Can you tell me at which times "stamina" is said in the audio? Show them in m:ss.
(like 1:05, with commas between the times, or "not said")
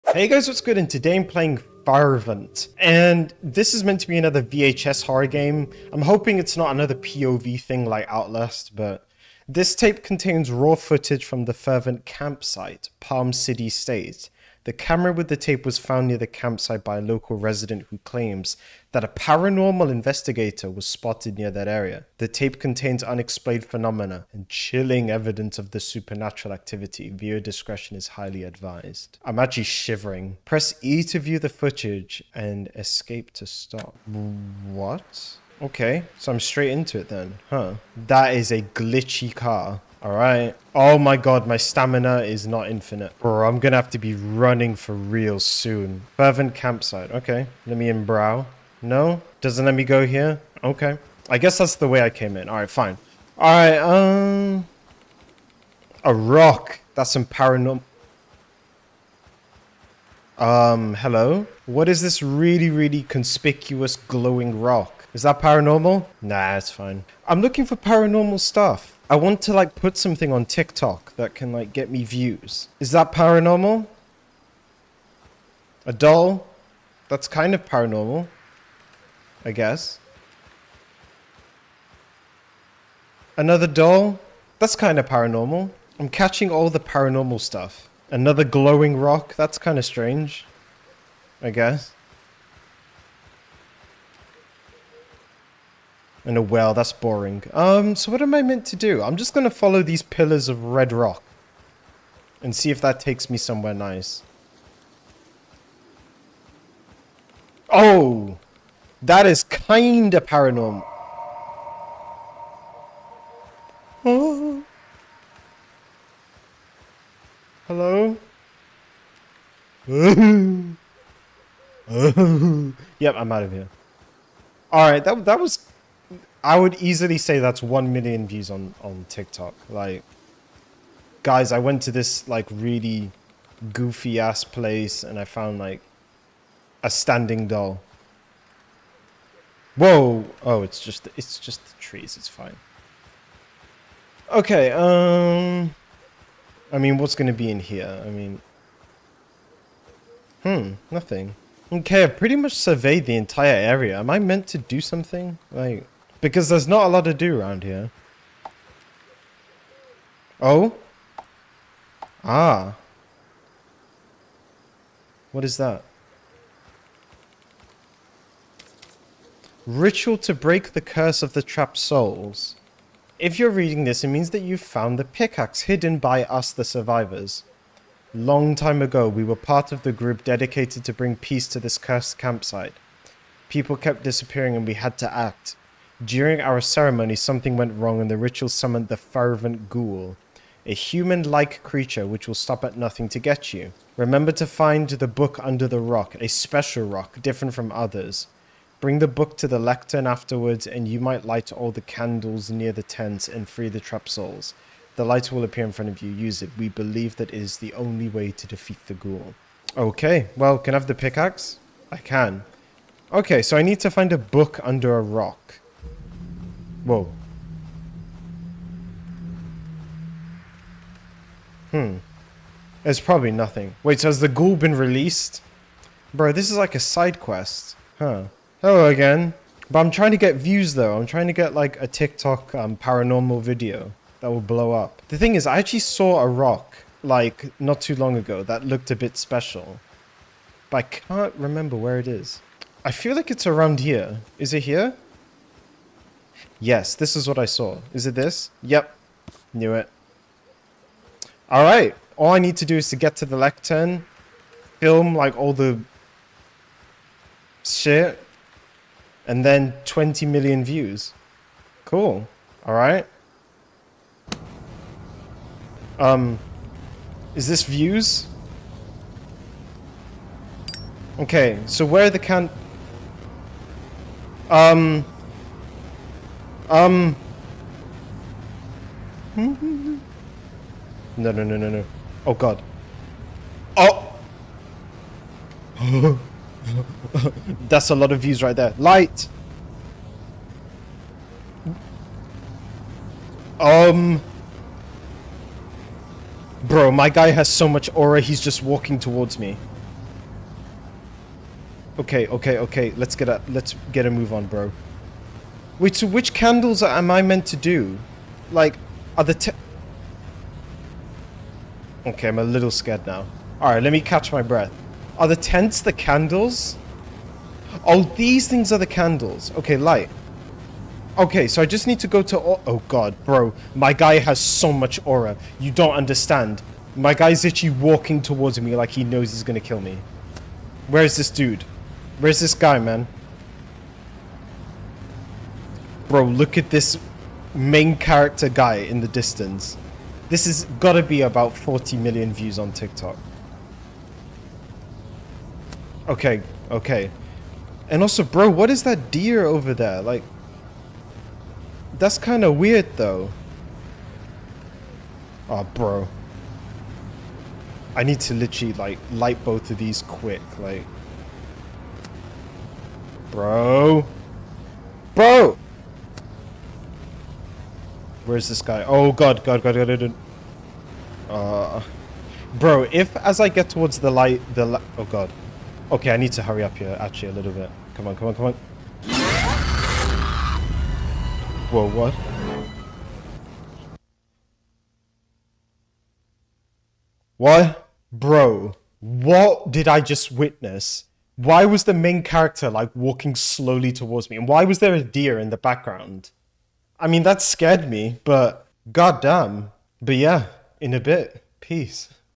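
0:41.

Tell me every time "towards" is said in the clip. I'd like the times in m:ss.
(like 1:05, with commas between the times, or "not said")
4:58, 5:28, 6:13, 6:33.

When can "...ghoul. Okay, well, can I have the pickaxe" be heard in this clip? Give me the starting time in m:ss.
3:28.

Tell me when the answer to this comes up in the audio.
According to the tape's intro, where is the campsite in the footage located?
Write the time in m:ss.
0:12.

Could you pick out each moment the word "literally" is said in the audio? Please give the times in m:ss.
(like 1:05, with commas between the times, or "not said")
5:27, 5:58.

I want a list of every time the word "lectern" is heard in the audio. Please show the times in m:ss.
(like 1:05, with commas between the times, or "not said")
3:19, 4:13.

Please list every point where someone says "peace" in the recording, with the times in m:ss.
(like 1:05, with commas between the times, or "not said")
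3:01, 6:41.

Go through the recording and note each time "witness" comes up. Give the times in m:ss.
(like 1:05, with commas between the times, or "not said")
6:30.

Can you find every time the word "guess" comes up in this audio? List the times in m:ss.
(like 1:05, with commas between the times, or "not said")
0:51, 1:19, 1:31.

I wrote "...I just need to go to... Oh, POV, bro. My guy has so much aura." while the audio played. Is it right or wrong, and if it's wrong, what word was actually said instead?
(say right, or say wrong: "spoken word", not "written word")
wrong: "God", not "POV".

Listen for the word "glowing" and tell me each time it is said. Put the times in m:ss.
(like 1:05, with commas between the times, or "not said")
1:03, 1:28.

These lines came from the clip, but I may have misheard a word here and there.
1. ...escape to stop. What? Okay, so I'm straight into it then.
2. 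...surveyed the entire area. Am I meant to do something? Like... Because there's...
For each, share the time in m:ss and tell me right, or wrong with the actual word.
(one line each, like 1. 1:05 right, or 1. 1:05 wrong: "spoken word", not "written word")
1. 0:32 right
2. 2:32 right.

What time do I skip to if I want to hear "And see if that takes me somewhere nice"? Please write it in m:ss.
1:42.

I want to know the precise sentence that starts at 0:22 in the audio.
The tape contains unexplained phenomena and chilling evidence of the supernatural activity.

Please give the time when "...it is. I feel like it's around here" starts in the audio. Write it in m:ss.
4:01.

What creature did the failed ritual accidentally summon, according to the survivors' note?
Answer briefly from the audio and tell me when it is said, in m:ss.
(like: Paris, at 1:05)
fervent ghoul, at 3:08.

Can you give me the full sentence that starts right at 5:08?
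Like, are the Okay, I'm a little scared now.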